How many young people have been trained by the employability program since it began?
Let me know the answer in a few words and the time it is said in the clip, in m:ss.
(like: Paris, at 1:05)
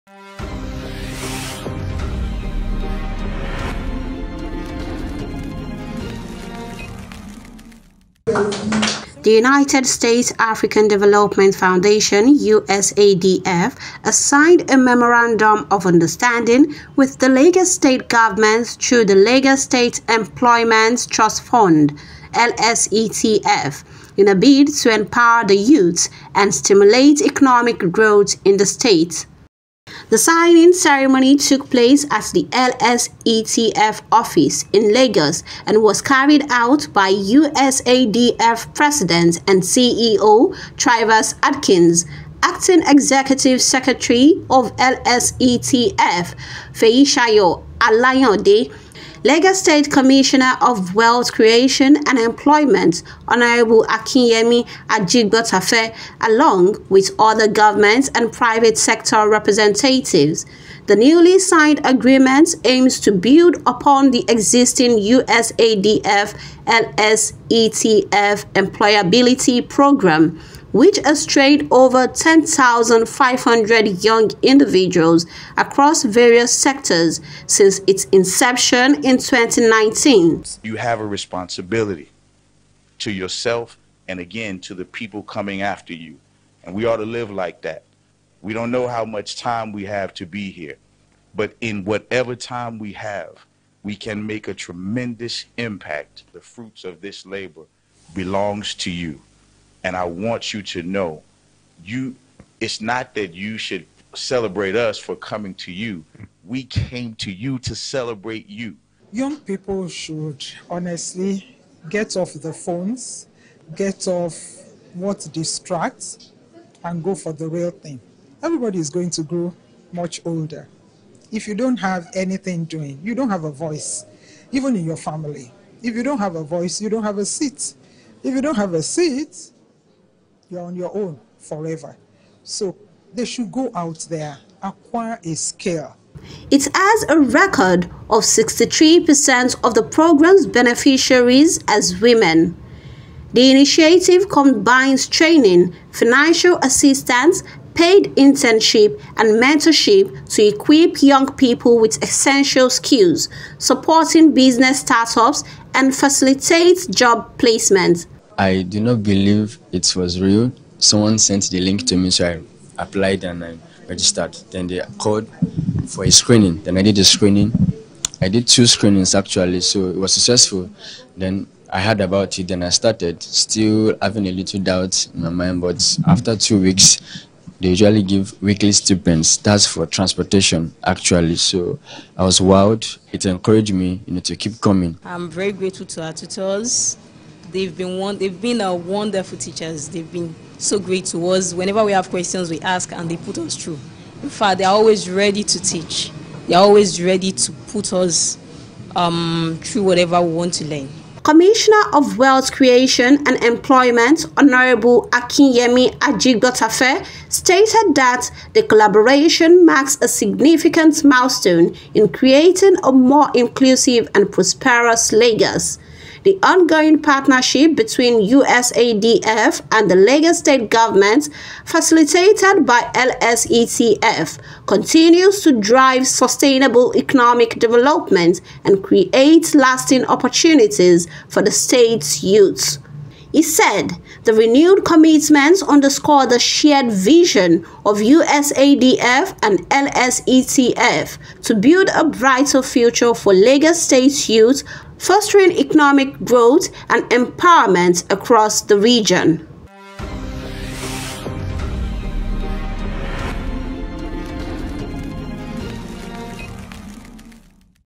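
10,500, at 1:12.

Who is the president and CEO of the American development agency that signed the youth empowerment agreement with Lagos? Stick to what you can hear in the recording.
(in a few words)
Travis Adkins.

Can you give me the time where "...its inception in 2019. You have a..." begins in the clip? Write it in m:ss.
1:17.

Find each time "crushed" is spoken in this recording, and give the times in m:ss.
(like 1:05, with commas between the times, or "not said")
not said.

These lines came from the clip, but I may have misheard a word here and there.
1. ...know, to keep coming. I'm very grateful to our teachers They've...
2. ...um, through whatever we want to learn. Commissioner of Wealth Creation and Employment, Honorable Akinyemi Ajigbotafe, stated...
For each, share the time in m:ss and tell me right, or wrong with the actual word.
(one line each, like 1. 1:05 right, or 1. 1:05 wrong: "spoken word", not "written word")
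1. 3:04 wrong: "tutors", not "teachers"
2. 3:18 right.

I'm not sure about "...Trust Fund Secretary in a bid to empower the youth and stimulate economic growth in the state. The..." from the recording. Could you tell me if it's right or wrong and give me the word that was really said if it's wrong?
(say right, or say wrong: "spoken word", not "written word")
wrong: "LSETF", not "Secretary".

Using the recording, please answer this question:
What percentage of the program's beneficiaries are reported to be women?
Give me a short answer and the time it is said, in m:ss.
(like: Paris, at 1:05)
63%, at 2:18.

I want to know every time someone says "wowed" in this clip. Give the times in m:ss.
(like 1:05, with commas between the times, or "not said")
3:02.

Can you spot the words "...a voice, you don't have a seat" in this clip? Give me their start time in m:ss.
2:06.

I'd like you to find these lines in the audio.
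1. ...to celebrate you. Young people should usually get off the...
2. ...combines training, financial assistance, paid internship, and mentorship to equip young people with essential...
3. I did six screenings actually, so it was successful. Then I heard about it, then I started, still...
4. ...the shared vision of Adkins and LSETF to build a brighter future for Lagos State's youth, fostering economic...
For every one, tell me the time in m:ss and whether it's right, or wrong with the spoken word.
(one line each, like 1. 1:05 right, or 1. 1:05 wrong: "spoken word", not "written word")
1. 1:47 wrong: "honestly", not "usually"
2. 2:24 right
3. 2:48 wrong: "two", not "six"
4. 3:56 wrong: "USADF", not "Adkins".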